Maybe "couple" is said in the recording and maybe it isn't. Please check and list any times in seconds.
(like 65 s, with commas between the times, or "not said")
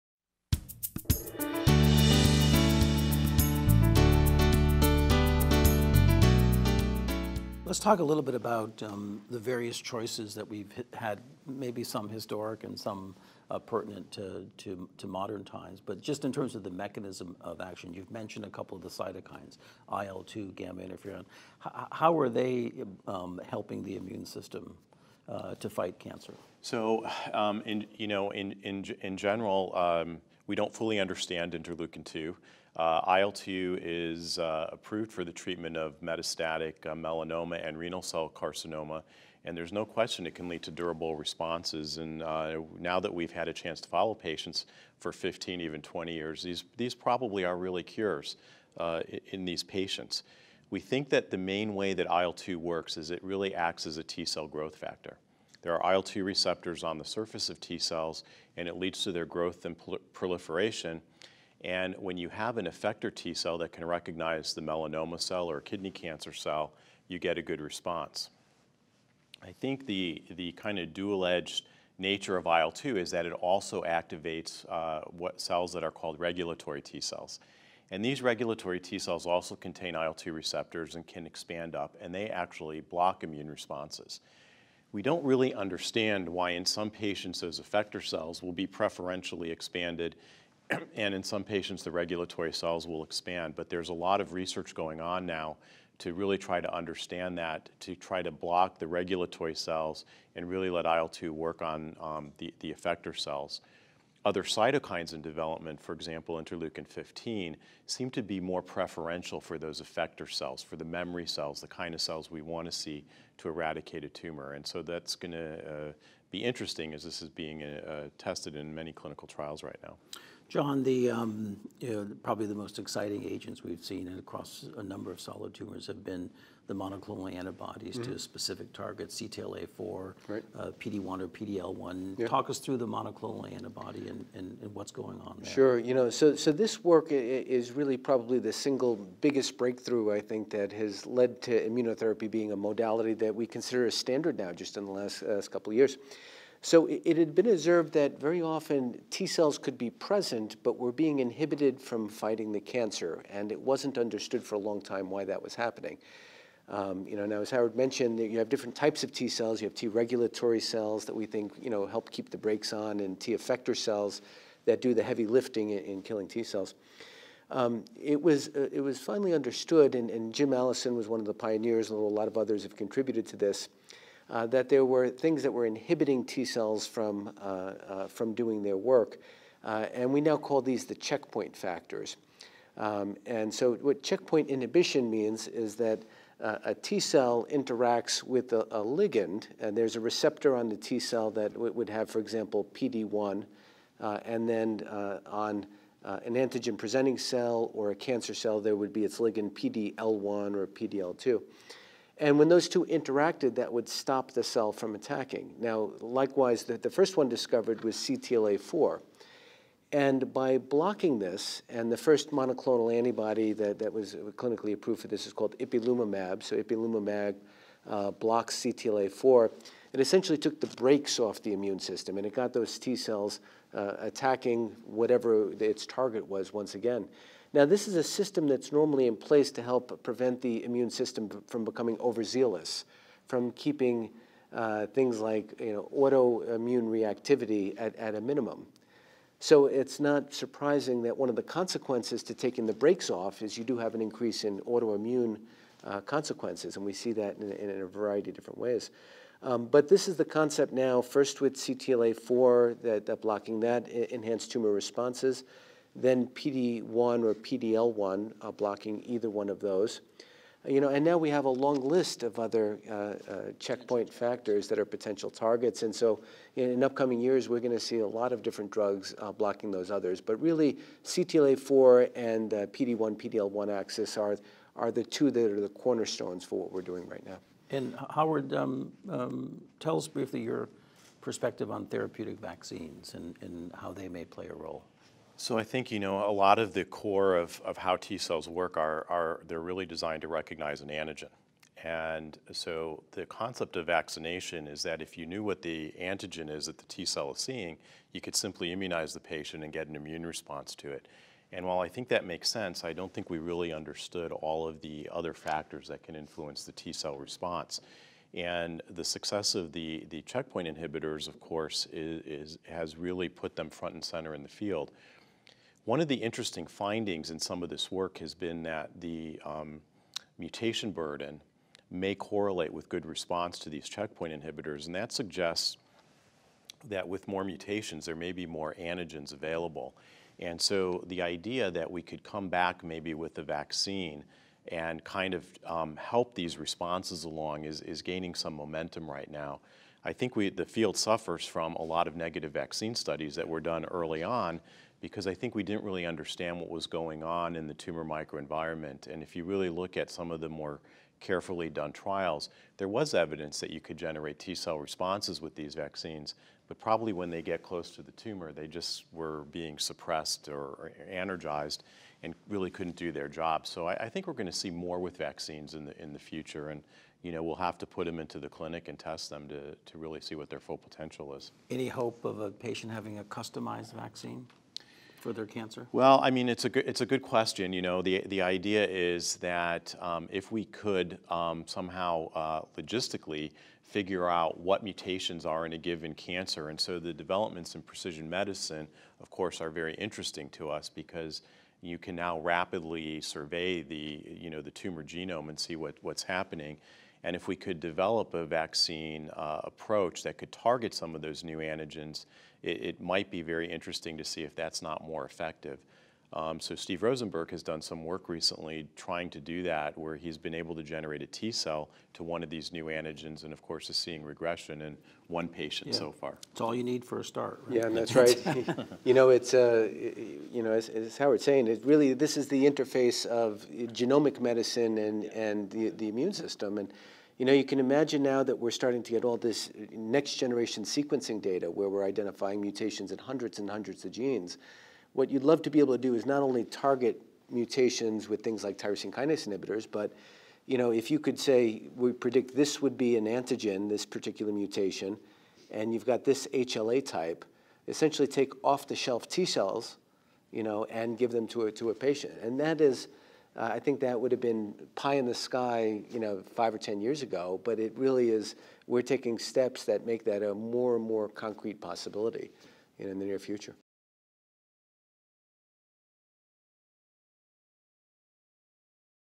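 18 s, 145 s.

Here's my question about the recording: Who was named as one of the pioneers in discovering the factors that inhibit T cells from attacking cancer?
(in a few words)
Jim Allison.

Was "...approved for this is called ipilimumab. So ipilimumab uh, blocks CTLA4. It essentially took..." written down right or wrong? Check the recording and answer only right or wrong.
right.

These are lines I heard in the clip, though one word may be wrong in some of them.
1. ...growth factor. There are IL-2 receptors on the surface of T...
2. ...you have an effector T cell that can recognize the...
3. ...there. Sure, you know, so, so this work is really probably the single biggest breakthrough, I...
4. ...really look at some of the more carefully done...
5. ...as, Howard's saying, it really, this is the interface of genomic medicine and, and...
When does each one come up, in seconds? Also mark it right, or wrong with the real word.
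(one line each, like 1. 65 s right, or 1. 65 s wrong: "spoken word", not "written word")
1. 54 s right
2. 62 s right
3. 135 s right
4. 349 s right
5. 420 s right.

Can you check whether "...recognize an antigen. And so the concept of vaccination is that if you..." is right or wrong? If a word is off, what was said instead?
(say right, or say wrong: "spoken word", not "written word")
right.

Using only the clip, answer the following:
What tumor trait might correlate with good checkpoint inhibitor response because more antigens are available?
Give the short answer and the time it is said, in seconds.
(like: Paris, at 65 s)
mutation burden, at 320 s.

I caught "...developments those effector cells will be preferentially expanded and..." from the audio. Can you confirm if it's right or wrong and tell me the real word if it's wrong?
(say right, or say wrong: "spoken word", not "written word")
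wrong: "patients", not "developments".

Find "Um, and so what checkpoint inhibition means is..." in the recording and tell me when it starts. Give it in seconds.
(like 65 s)
182 s.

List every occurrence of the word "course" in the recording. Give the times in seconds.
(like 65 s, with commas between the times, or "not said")
311 s, 389 s, 413 s.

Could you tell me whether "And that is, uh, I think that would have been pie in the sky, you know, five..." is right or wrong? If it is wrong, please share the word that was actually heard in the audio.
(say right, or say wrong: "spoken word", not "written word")
right.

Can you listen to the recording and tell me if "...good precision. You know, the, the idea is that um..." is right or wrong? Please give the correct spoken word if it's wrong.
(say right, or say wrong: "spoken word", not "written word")
wrong: "question", not "precision".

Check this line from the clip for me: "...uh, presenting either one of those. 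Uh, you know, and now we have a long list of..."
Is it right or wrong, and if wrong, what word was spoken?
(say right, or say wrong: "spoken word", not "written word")
wrong: "blocking", not "presenting".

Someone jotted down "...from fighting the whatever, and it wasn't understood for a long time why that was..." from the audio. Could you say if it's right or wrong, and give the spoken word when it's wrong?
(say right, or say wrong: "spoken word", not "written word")
wrong: "cancer", not "whatever".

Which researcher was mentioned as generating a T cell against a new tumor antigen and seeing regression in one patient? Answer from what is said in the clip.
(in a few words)
Steve Rosenberg.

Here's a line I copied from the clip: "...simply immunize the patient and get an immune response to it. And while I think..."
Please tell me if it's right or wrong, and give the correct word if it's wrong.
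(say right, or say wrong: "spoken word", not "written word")
right.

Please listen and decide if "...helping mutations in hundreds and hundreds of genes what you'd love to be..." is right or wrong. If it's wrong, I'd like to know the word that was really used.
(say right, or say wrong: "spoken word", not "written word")
wrong: "identifying", not "helping".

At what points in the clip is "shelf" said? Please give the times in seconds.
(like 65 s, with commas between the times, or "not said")
448 s.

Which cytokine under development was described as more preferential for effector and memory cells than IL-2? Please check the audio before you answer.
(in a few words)
interleukin 15.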